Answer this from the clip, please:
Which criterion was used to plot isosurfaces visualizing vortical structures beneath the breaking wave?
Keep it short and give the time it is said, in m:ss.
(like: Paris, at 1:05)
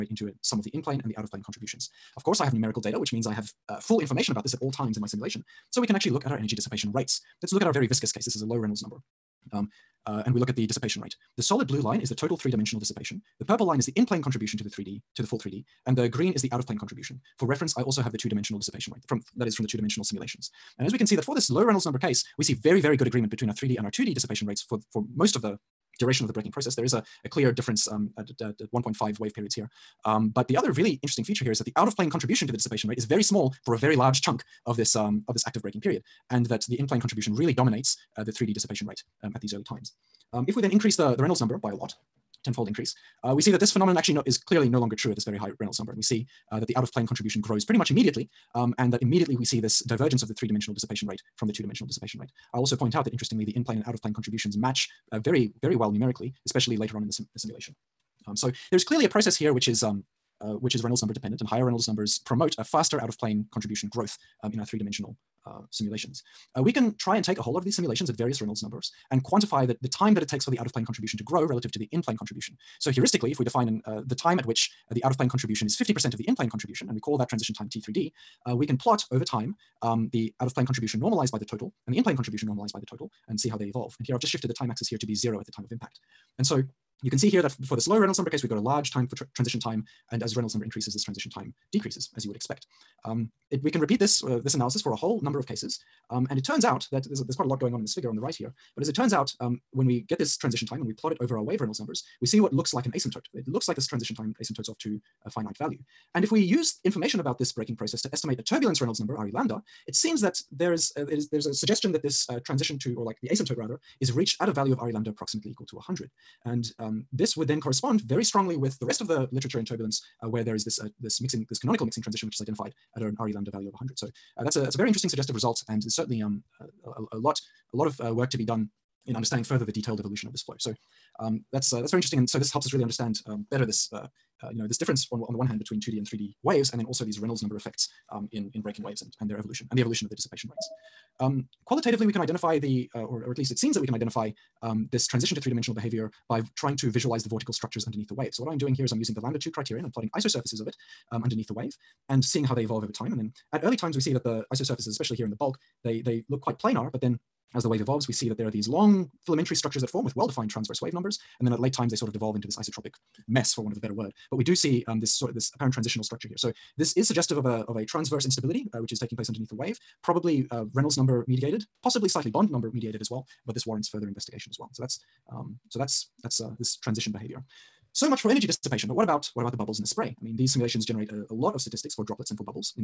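lambda 2 criterion, at 2:29.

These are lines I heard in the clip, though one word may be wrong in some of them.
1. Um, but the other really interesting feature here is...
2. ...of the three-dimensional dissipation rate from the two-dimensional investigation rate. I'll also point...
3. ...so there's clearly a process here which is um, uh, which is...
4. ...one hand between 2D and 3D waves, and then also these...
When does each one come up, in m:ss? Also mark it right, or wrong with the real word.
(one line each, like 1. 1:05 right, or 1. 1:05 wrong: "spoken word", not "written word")
1. 0:30 right
2. 0:50 wrong: "dissipation", not "investigation"
3. 0:58 right
4. 2:15 right.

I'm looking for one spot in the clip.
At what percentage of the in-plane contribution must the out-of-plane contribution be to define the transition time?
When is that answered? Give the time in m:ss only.
1:15.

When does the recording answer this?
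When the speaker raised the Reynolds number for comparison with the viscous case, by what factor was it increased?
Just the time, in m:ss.
0:42.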